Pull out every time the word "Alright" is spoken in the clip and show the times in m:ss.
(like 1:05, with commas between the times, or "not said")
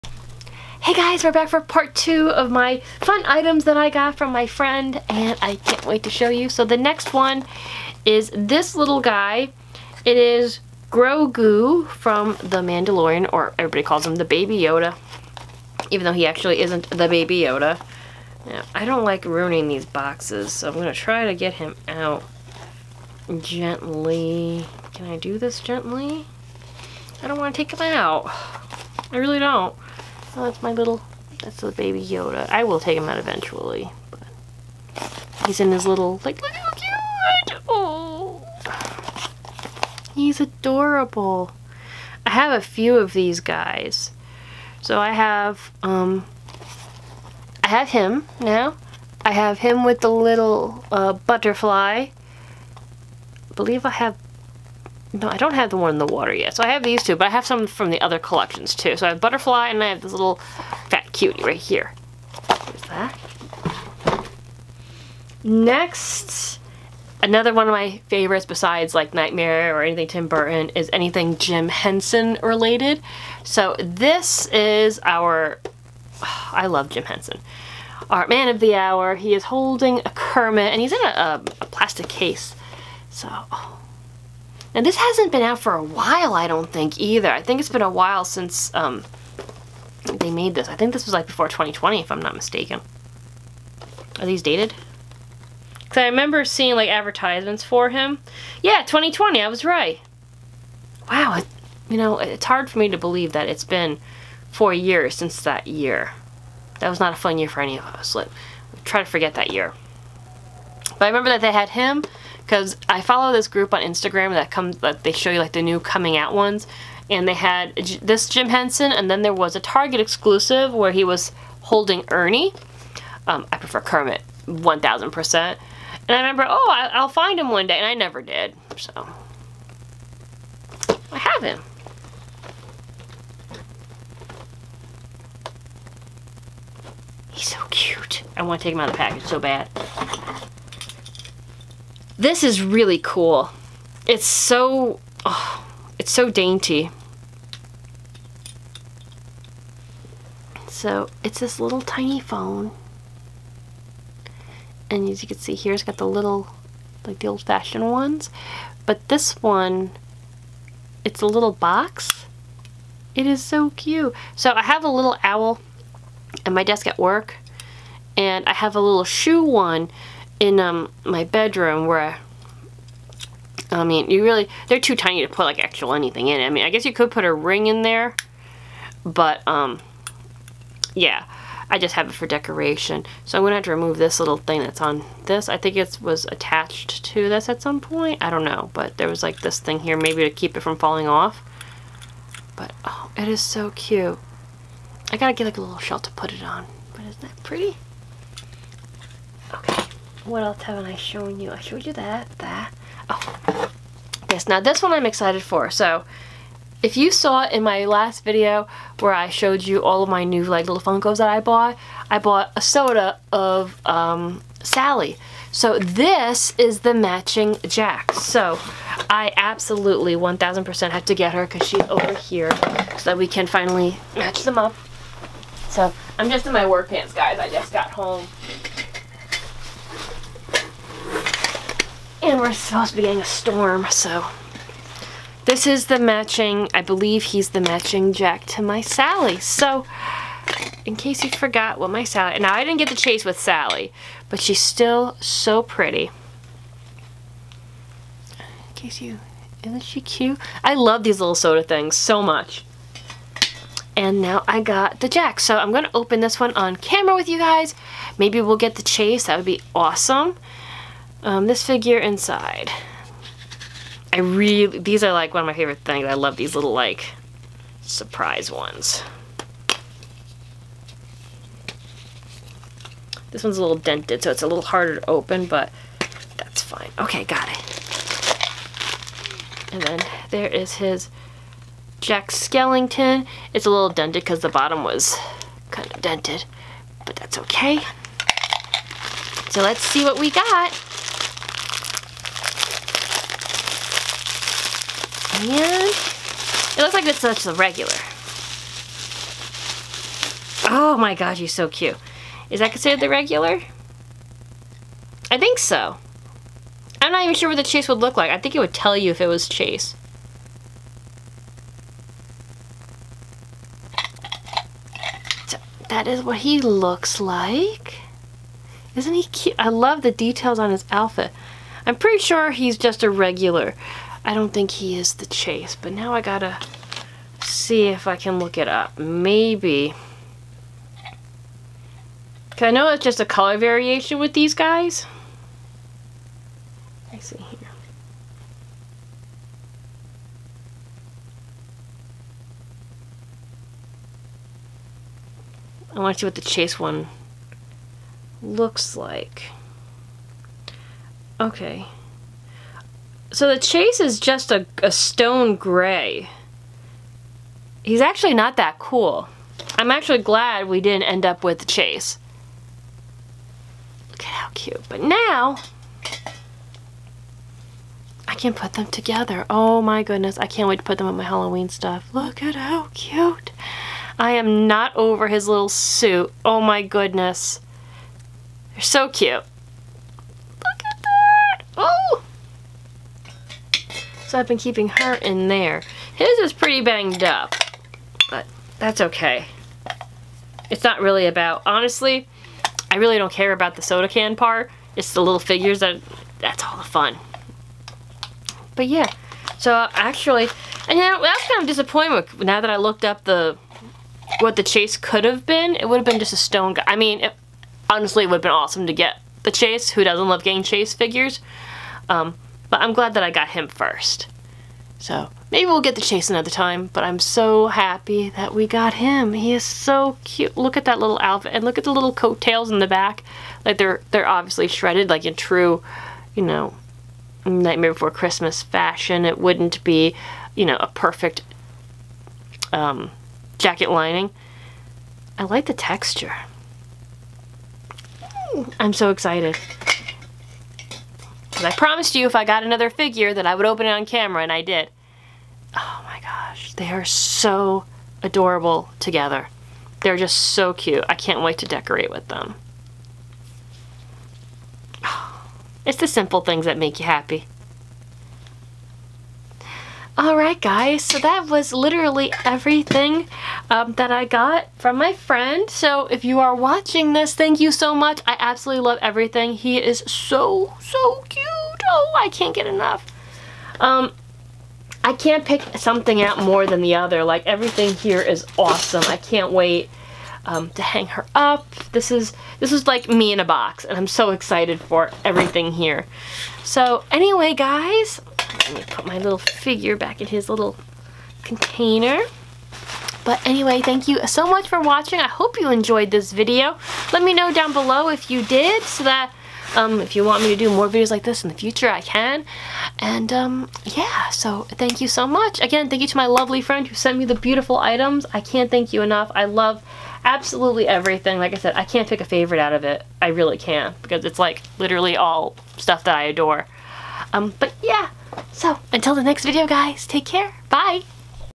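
7:40.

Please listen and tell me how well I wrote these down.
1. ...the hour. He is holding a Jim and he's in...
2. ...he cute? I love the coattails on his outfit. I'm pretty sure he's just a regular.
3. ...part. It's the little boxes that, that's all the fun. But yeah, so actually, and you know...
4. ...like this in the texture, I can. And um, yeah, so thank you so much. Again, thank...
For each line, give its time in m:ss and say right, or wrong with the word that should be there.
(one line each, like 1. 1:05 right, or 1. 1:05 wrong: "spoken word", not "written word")
1. 1:18 wrong: "Kermit", not "Jim"
2. 5:19 wrong: "details", not "coattails"
3. 6:34 wrong: "figures", not "boxes"
4. 8:21 wrong: "future", not "texture".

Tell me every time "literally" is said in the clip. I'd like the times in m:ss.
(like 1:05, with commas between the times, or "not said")
7:41, 8:34.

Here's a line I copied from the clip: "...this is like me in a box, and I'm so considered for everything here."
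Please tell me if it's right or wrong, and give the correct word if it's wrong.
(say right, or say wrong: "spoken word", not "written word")
wrong: "excited", not "considered".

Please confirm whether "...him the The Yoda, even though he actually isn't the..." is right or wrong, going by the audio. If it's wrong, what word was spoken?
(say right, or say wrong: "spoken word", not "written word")
wrong: "Baby", not "The".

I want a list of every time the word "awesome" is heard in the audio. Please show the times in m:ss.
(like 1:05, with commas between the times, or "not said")
4:19, 6:48, 7:58.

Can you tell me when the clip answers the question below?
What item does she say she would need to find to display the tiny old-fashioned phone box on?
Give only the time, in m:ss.
3:15.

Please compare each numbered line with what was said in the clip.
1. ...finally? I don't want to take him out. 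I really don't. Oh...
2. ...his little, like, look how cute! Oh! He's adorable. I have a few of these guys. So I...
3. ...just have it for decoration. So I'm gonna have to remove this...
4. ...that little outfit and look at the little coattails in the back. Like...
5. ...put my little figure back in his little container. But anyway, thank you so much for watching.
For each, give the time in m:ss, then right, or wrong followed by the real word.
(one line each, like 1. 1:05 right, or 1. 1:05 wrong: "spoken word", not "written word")
1. 0:25 wrong: "gently", not "finally"
2. 0:35 right
3. 3:01 right
4. 7:00 right
5. 8:08 right.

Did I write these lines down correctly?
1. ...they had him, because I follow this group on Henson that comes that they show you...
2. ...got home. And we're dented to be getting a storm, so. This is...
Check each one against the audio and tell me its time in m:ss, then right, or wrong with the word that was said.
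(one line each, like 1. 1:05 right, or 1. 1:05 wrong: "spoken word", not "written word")
1. 1:51 wrong: "Instagram", not "Henson"
2. 3:47 wrong: "supposed", not "dented".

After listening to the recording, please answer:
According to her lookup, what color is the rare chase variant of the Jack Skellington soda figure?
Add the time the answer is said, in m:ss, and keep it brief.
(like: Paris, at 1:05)
stone gray, at 5:54.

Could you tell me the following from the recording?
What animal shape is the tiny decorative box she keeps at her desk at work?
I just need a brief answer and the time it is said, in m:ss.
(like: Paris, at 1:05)
owl, at 2:45.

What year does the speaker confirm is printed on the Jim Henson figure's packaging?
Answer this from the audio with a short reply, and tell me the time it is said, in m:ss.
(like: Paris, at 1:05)
2020, at 1:38.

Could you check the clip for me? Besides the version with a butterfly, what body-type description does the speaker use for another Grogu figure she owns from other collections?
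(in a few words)
little fat cutie.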